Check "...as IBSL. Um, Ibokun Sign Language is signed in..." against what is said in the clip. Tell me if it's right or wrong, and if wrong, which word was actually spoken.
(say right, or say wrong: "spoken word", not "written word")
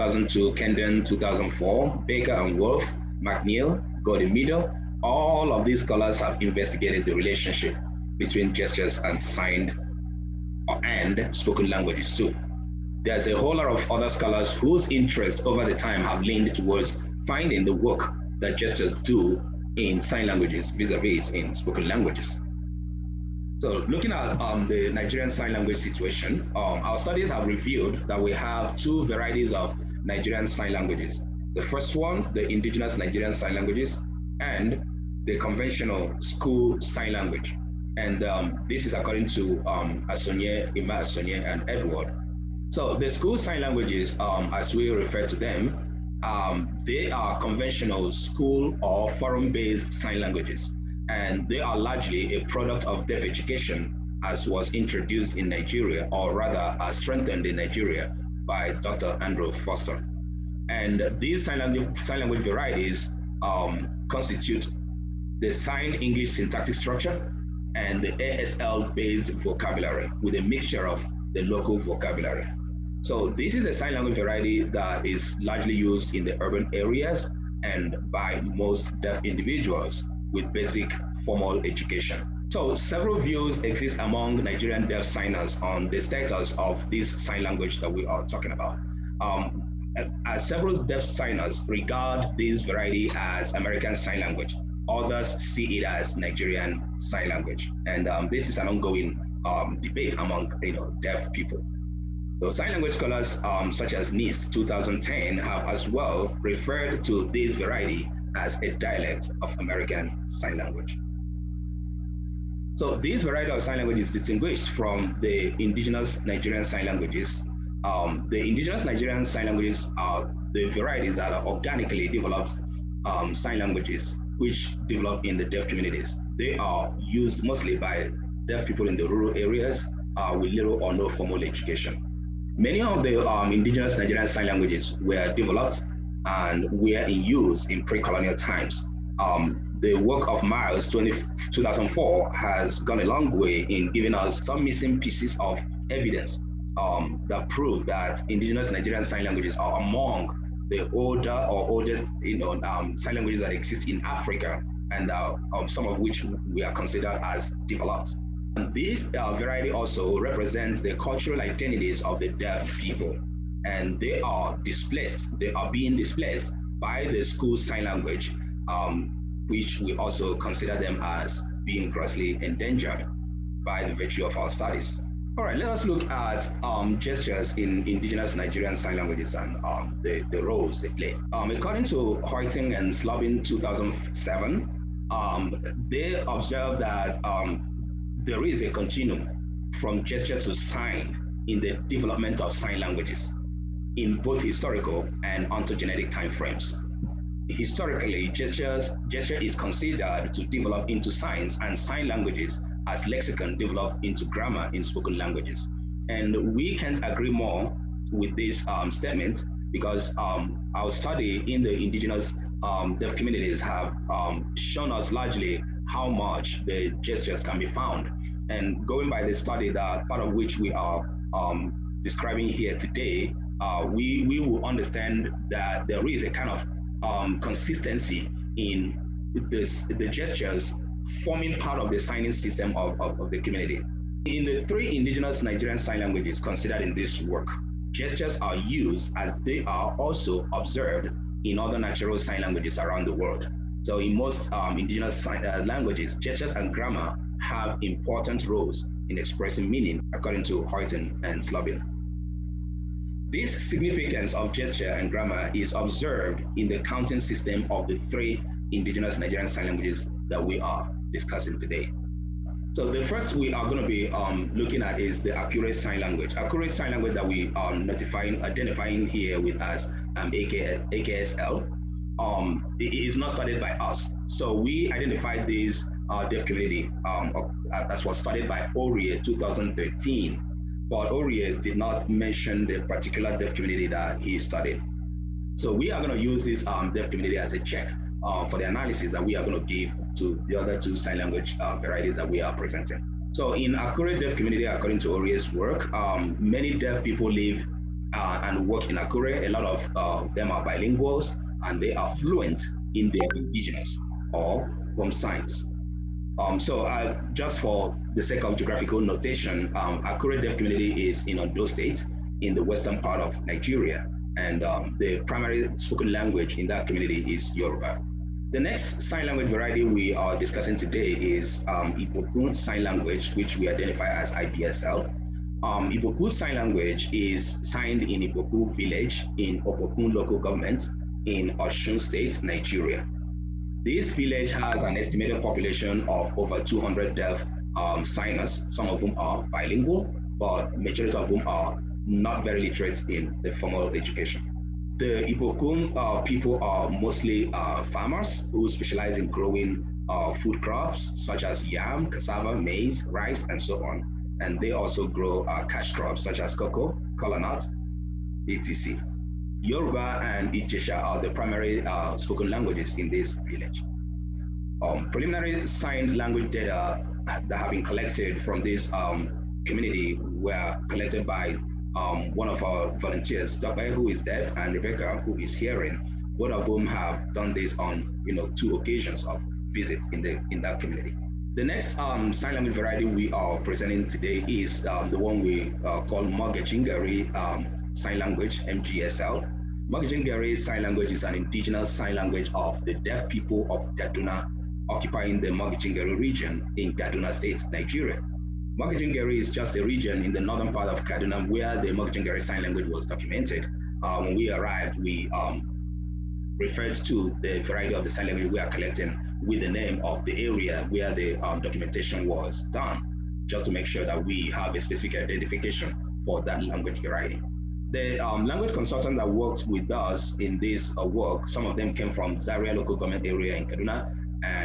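right.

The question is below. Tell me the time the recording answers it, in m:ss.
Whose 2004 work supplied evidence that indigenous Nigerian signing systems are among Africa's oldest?
2:20.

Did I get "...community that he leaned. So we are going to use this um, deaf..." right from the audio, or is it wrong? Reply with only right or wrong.
wrong.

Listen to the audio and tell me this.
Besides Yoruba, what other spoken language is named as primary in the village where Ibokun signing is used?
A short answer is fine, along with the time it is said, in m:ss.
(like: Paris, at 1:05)
Ijesha, at 6:00.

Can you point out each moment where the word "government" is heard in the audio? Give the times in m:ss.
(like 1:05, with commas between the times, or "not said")
5:30, 7:02.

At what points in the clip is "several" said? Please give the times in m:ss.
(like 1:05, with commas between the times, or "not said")
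1:22, 1:30.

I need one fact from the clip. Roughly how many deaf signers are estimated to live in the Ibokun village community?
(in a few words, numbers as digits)
over 200.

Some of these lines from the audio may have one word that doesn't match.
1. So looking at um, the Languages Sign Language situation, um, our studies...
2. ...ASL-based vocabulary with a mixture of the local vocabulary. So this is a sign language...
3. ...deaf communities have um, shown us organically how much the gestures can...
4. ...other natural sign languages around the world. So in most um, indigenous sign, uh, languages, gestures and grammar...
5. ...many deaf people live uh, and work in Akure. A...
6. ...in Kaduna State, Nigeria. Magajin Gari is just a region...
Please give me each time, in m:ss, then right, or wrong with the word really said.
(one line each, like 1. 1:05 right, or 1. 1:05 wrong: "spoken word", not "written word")
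1. 0:23 wrong: "Nigerian", not "Languages"
2. 1:08 right
3. 3:32 wrong: "largely", not "organically"
4. 4:01 right
5. 4:56 right
6. 6:36 right.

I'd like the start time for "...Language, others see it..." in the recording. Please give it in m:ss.
1:34.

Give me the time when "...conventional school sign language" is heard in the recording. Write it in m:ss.
0:35.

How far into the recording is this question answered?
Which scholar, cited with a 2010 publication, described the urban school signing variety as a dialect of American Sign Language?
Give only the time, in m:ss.
1:44.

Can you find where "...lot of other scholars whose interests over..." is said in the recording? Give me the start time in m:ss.
0:13.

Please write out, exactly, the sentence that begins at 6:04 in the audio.
Um, preliminary signed language data that have been collected from this um, community were collected by um, one of our volunteers, Dr.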